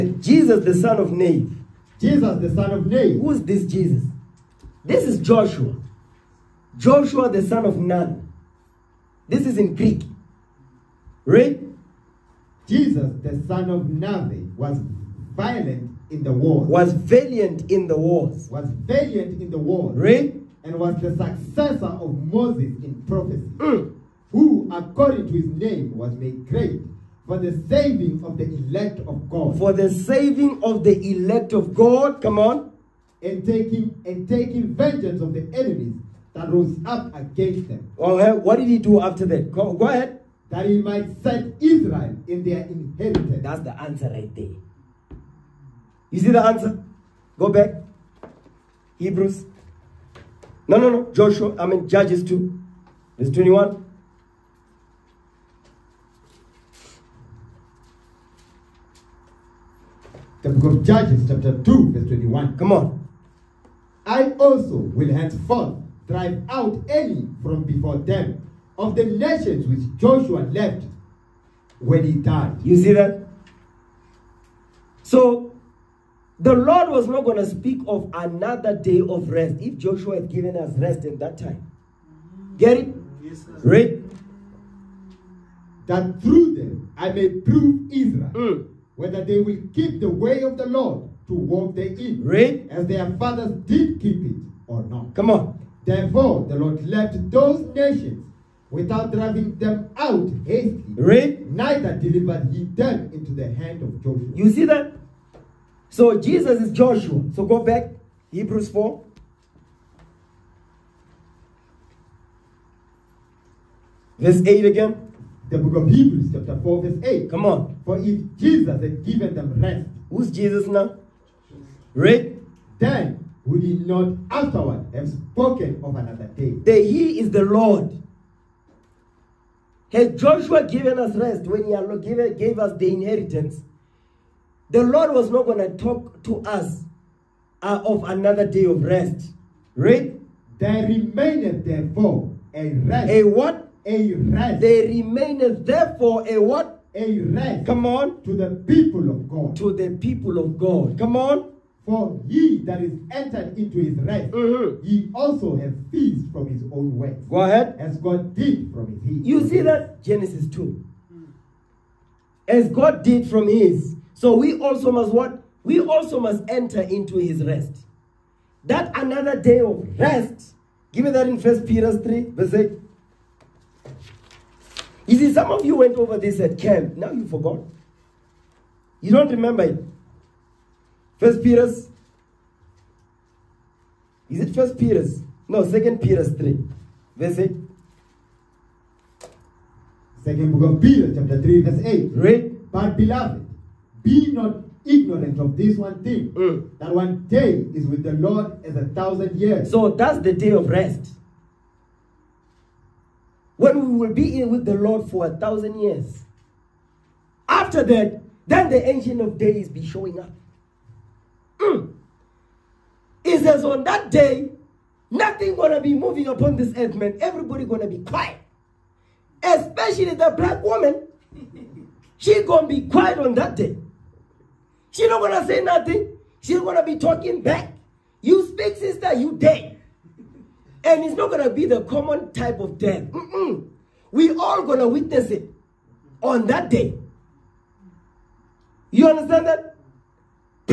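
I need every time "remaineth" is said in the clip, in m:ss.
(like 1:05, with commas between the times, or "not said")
2:20, 2:24.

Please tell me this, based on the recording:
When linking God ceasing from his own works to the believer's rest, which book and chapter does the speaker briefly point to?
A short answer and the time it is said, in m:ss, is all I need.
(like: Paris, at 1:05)
Genesis 2, at 2:40.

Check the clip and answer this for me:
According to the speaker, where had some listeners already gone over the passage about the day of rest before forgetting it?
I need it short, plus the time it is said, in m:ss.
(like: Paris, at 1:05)
At camp, at 2:56.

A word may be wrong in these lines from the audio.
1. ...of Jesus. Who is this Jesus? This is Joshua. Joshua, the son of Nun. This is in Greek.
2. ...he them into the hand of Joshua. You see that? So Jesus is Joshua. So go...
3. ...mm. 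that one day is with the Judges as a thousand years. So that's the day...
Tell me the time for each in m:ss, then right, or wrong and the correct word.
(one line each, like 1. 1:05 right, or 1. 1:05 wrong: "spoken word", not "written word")
1. 0:02 wrong: "Nave", not "Jesus"
2. 1:42 right
3. 3:16 wrong: "Lord", not "Judges".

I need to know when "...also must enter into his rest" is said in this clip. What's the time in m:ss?
2:45.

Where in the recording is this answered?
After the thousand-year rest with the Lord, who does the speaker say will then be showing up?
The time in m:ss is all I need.
3:28.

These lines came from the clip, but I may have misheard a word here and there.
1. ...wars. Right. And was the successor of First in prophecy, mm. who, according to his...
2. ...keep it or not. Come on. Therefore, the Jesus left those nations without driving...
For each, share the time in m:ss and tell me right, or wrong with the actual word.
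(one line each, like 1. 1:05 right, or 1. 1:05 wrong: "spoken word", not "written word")
1. 0:19 wrong: "Moses", not "First"
2. 1:34 wrong: "Lord", not "Jesus".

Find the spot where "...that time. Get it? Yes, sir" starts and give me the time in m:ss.
1:21.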